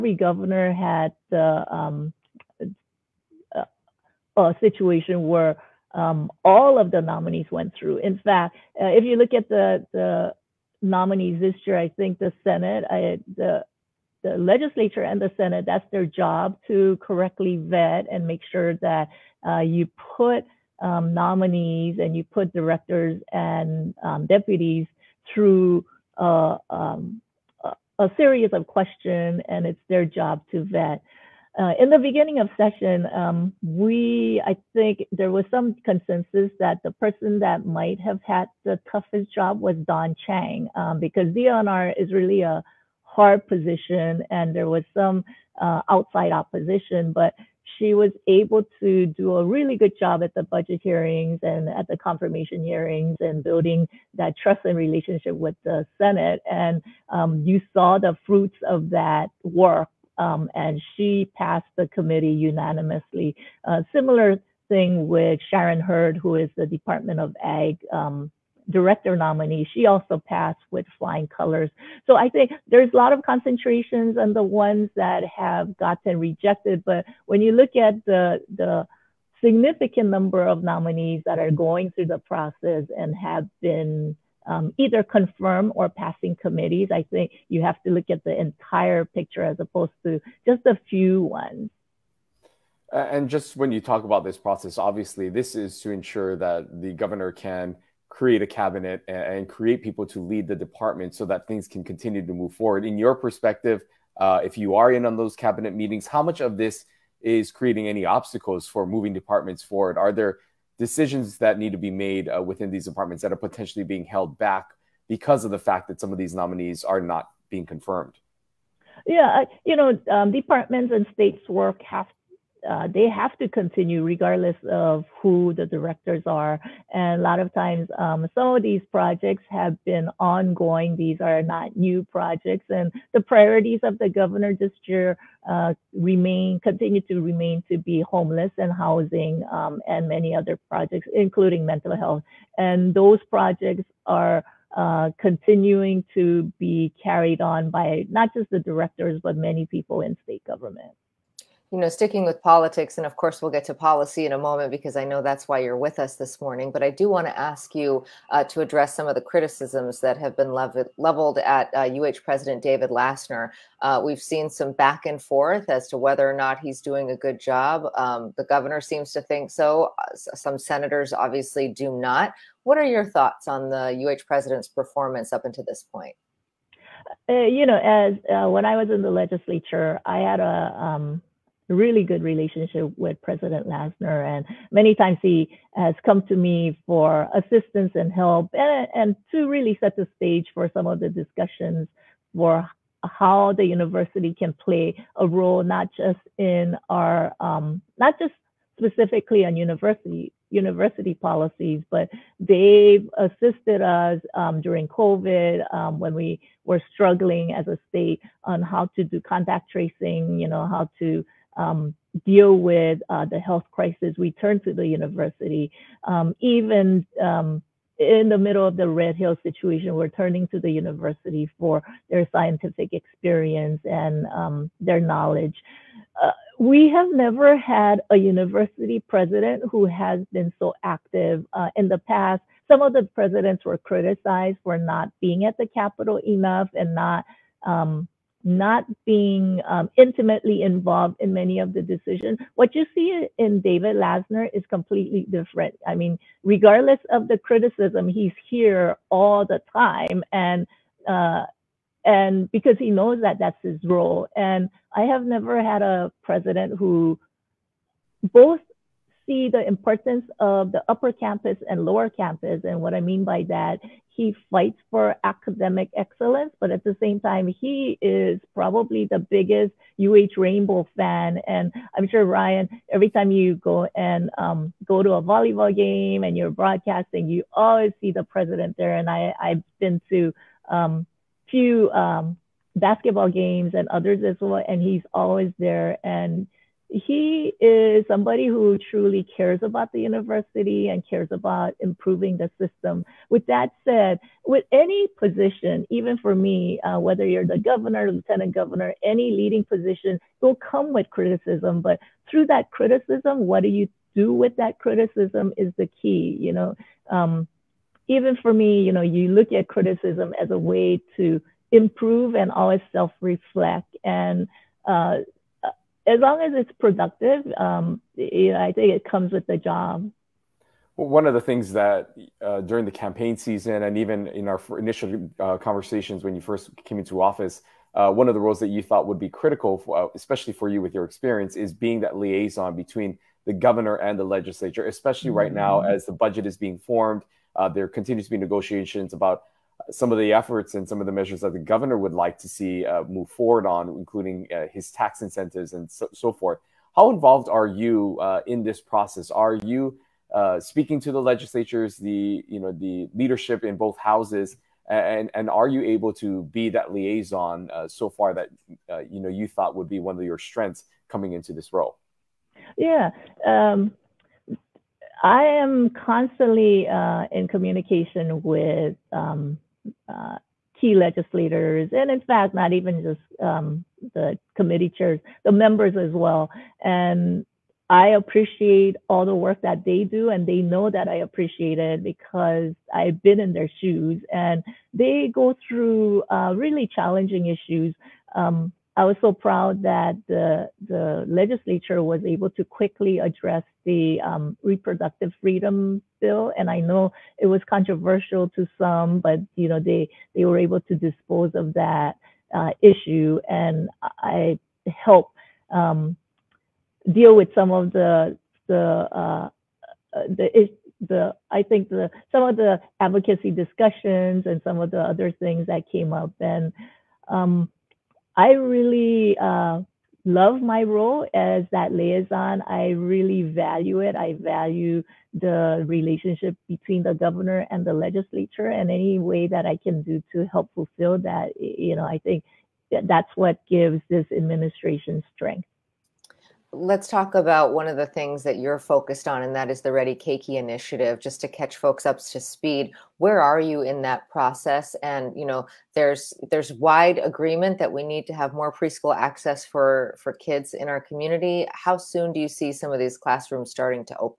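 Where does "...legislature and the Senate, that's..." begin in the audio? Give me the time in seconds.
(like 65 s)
14 s.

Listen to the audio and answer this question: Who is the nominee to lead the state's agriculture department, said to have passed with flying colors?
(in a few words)
Sharon Hurd.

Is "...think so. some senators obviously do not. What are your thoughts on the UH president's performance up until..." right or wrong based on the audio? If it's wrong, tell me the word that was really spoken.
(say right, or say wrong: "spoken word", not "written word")
right.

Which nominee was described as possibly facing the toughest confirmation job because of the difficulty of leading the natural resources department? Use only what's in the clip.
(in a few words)
Dawn Chang.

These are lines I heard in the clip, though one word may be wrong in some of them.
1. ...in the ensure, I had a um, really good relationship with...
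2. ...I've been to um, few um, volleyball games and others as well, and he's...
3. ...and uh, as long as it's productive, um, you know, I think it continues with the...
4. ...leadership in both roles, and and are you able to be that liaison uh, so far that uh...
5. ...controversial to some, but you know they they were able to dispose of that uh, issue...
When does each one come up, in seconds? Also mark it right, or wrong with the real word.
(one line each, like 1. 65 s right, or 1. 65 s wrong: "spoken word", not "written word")
1. 178 s wrong: "legislature", not "ensure"
2. 279 s wrong: "basketball", not "volleyball"
3. 314 s wrong: "comes", not "continues"
4. 353 s wrong: "houses", not "roles"
5. 397 s right.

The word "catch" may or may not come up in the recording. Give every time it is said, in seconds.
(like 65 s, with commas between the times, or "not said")
441 s.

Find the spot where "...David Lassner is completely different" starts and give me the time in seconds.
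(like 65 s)
243 s.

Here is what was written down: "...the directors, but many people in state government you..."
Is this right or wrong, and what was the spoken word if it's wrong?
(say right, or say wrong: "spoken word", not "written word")
right.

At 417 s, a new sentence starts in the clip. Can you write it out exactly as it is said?
Um, I really uh, love my role as that liaison.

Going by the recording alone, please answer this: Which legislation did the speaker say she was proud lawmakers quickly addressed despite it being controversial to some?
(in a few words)
reproductive freedom bill.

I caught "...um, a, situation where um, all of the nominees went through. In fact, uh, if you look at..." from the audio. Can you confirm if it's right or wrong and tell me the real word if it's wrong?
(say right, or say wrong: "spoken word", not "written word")
right.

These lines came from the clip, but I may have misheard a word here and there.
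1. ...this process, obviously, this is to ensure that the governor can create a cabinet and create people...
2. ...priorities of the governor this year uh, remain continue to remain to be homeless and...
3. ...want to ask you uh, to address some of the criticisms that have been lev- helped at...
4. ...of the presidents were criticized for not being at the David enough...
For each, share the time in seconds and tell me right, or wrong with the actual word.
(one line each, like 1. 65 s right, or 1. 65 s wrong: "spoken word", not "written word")
1. 94 s right
2. 133 s right
3. 157 s wrong: "leveled", not "helped"
4. 232 s wrong: "Capitol", not "David".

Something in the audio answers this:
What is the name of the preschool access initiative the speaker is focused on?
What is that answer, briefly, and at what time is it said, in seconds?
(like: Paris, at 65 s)
Ready Keiki, at 439 s.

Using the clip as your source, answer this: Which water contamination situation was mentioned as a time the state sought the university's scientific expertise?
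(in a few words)
Red Hill.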